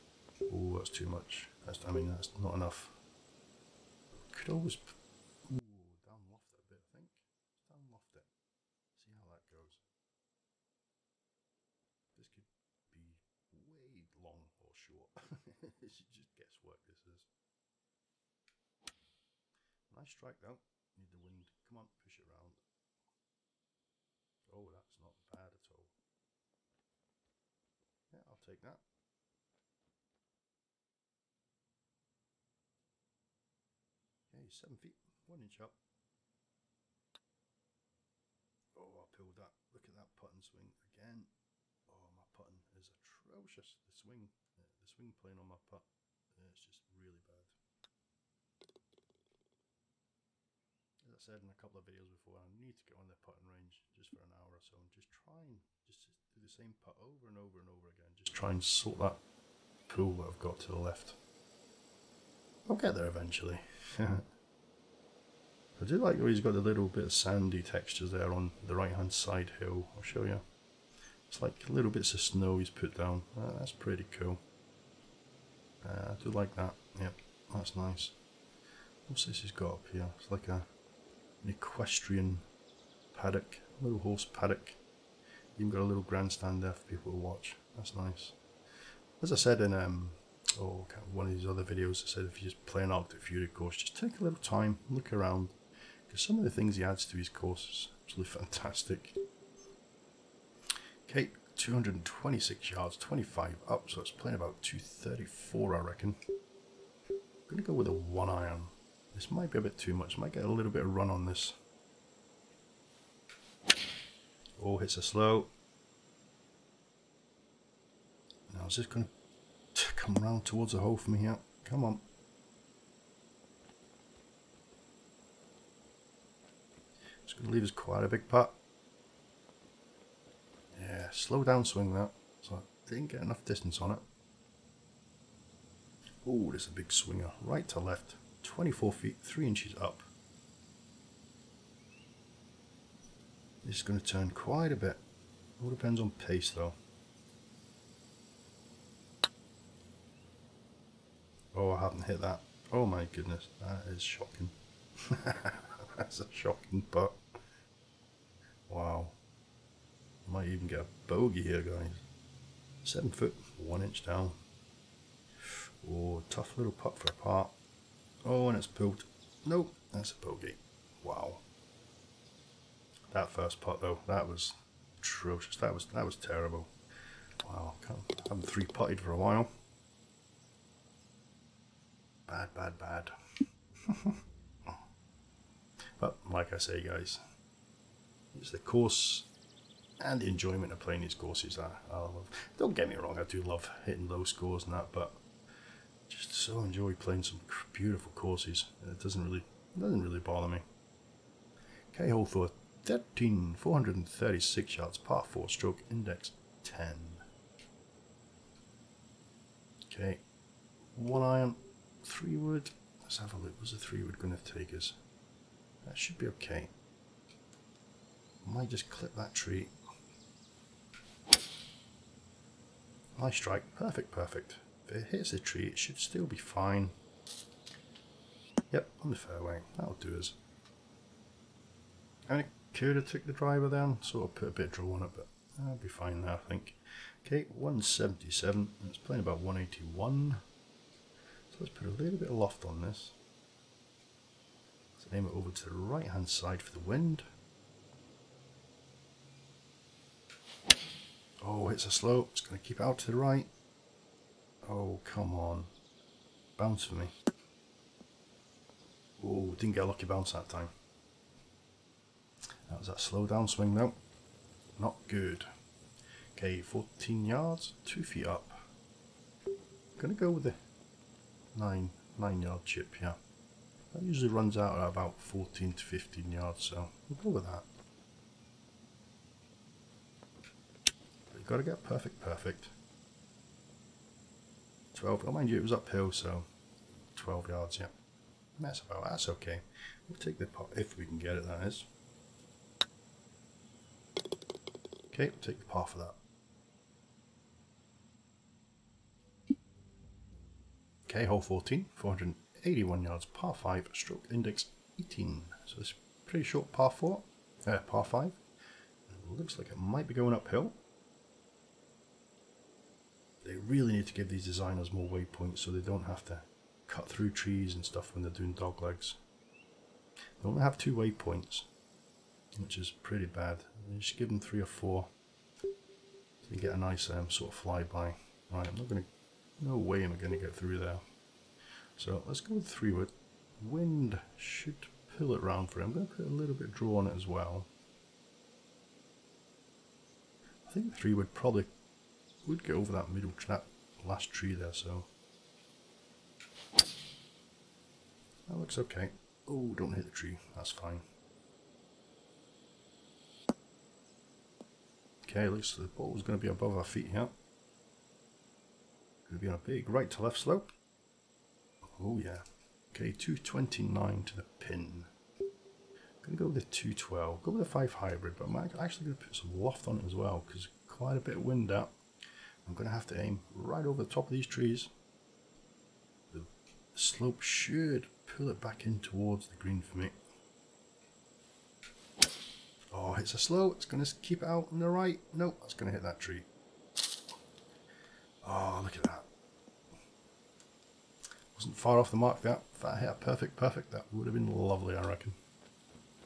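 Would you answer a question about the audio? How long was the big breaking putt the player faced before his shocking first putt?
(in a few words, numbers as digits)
24 feet, 3 inches.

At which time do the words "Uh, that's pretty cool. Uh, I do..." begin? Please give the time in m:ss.
1:13.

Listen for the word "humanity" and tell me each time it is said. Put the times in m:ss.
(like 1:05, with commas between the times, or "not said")
not said.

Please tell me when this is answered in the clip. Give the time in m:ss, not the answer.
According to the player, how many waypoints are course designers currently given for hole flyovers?
5:20.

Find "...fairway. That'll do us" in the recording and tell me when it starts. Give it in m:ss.
3:49.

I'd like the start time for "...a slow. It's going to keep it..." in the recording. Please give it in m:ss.
6:23.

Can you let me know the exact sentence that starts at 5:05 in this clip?
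So it's pretty short par 4, uh, par 5.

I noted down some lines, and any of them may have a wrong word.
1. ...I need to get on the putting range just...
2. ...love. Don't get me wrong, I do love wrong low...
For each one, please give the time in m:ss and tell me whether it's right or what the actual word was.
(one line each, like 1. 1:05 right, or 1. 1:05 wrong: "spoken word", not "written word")
1. 0:52 right
2. 3:11 wrong: "hitting", not "wrong".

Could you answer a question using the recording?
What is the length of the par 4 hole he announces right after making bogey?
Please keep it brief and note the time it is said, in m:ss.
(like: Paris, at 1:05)
436 yards, at 3:23.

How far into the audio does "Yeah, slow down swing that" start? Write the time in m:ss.
2:10.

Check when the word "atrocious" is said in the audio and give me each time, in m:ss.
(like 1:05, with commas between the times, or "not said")
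0:42, 2:54.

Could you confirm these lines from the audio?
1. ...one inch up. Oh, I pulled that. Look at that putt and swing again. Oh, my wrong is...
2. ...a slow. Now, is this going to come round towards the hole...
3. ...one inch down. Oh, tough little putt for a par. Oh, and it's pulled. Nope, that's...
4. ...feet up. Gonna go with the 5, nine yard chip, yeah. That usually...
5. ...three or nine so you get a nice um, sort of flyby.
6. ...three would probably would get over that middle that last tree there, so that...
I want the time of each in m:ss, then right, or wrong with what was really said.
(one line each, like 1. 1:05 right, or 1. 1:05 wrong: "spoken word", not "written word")
1. 0:35 wrong: "putting", not "wrong"
2. 1:54 right
3. 2:43 right
4. 4:28 wrong: "9", not "5"
5. 5:24 wrong: "four", not "nine"
6. 5:40 right.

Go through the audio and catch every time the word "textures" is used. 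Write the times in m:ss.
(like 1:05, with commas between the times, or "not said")
1:07.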